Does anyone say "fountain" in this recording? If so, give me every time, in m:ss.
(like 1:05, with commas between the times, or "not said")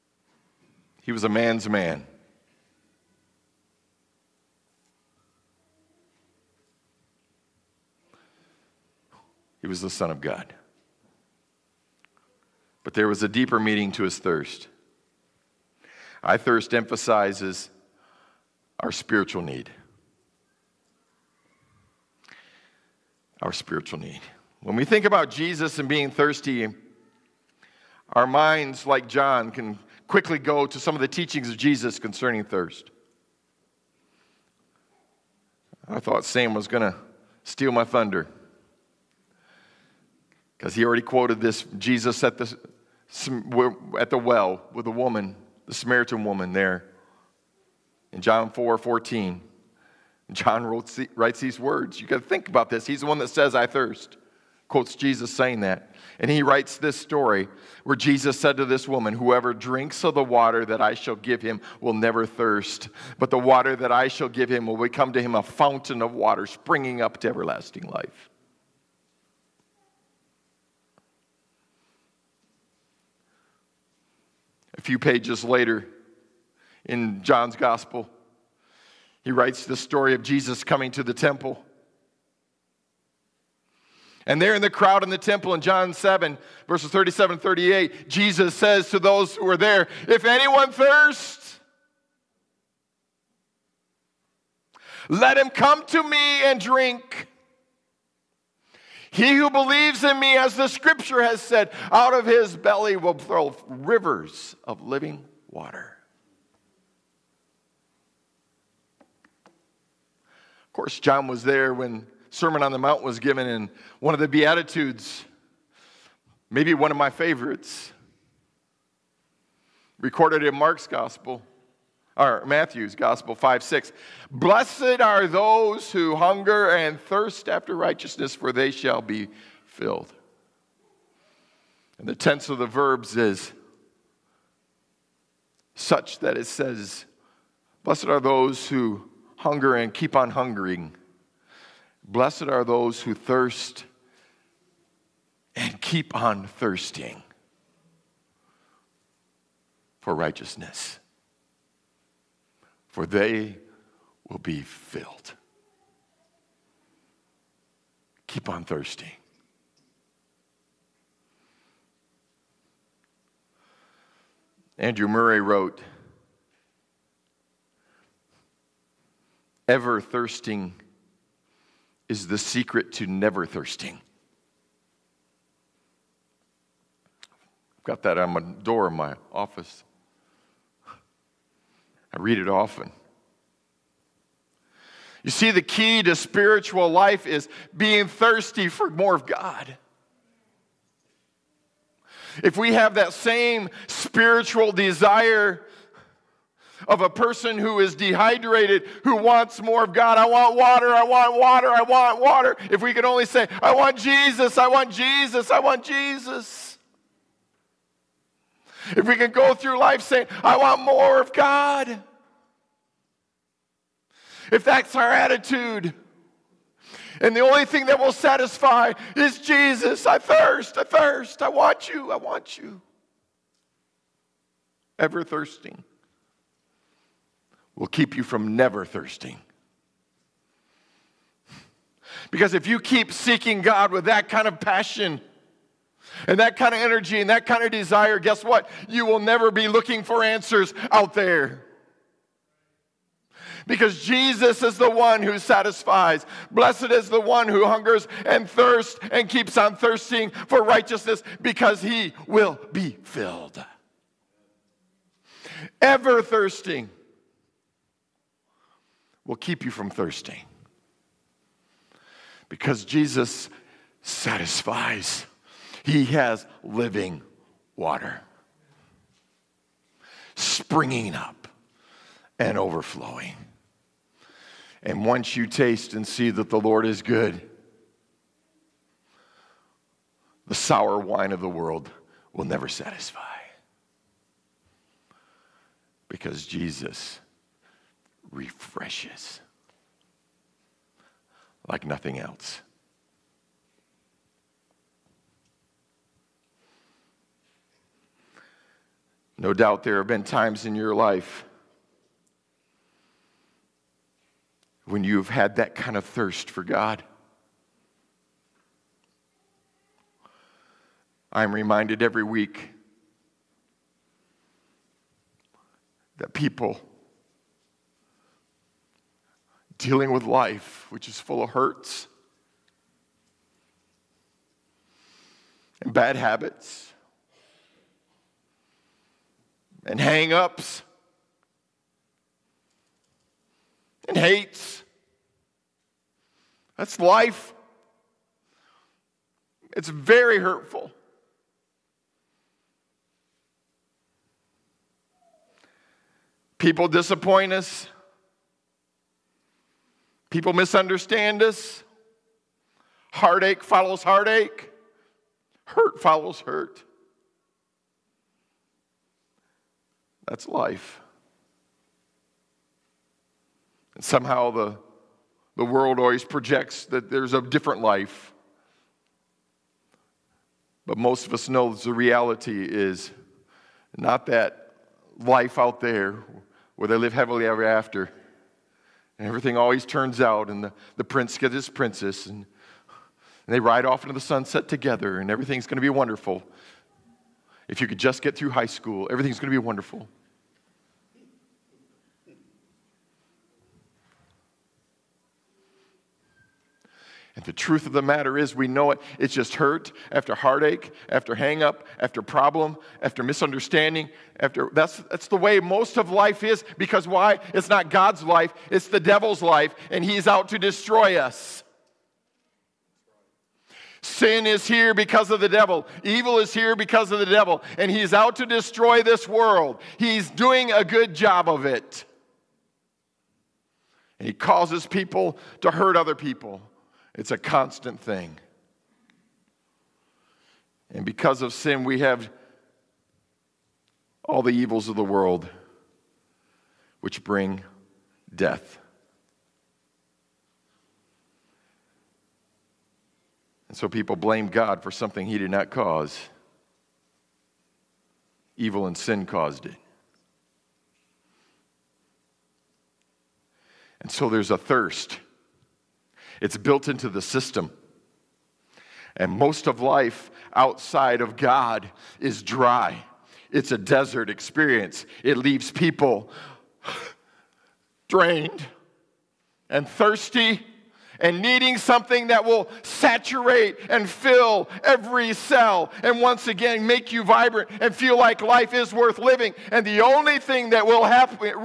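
1:05.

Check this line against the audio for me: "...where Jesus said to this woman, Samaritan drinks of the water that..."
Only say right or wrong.
wrong.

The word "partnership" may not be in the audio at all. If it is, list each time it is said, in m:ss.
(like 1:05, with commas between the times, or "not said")
not said.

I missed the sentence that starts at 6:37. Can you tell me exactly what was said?
And the truth of the matter is, we know it.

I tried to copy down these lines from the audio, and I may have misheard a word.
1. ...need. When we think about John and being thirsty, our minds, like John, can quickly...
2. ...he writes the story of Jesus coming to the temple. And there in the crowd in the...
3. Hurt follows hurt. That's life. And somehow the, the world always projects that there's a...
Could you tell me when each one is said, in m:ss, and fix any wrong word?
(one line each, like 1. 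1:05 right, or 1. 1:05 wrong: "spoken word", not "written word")
1. 0:23 wrong: "Jesus", not "John"
2. 1:19 right
3. 5:55 right.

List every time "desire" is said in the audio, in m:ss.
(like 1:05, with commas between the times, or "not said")
3:14, 3:57.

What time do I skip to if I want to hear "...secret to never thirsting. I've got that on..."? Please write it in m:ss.
2:52.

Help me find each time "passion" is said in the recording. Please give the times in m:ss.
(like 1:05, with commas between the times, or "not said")
3:54.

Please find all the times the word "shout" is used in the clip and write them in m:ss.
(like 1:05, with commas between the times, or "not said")
not said.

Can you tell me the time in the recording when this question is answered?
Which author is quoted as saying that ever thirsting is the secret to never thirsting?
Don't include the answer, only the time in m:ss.
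2:44.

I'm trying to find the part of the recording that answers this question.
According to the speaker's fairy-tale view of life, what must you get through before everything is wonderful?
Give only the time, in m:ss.
6:28.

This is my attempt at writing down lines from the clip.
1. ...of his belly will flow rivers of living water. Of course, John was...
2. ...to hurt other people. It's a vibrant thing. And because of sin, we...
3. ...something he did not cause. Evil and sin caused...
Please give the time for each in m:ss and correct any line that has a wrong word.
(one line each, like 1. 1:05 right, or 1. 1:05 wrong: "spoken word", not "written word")
1. 1:42 right
2. 7:05 wrong: "constant", not "vibrant"
3. 7:24 right.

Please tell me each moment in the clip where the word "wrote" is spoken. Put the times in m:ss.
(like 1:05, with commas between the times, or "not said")
0:50, 2:45.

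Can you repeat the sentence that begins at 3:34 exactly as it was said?
If that's our attitude, and the only thing that will satisfy is Jesus.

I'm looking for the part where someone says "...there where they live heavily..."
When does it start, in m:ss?
6:15.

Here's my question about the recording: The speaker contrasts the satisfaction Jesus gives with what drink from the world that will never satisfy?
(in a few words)
Sour wine.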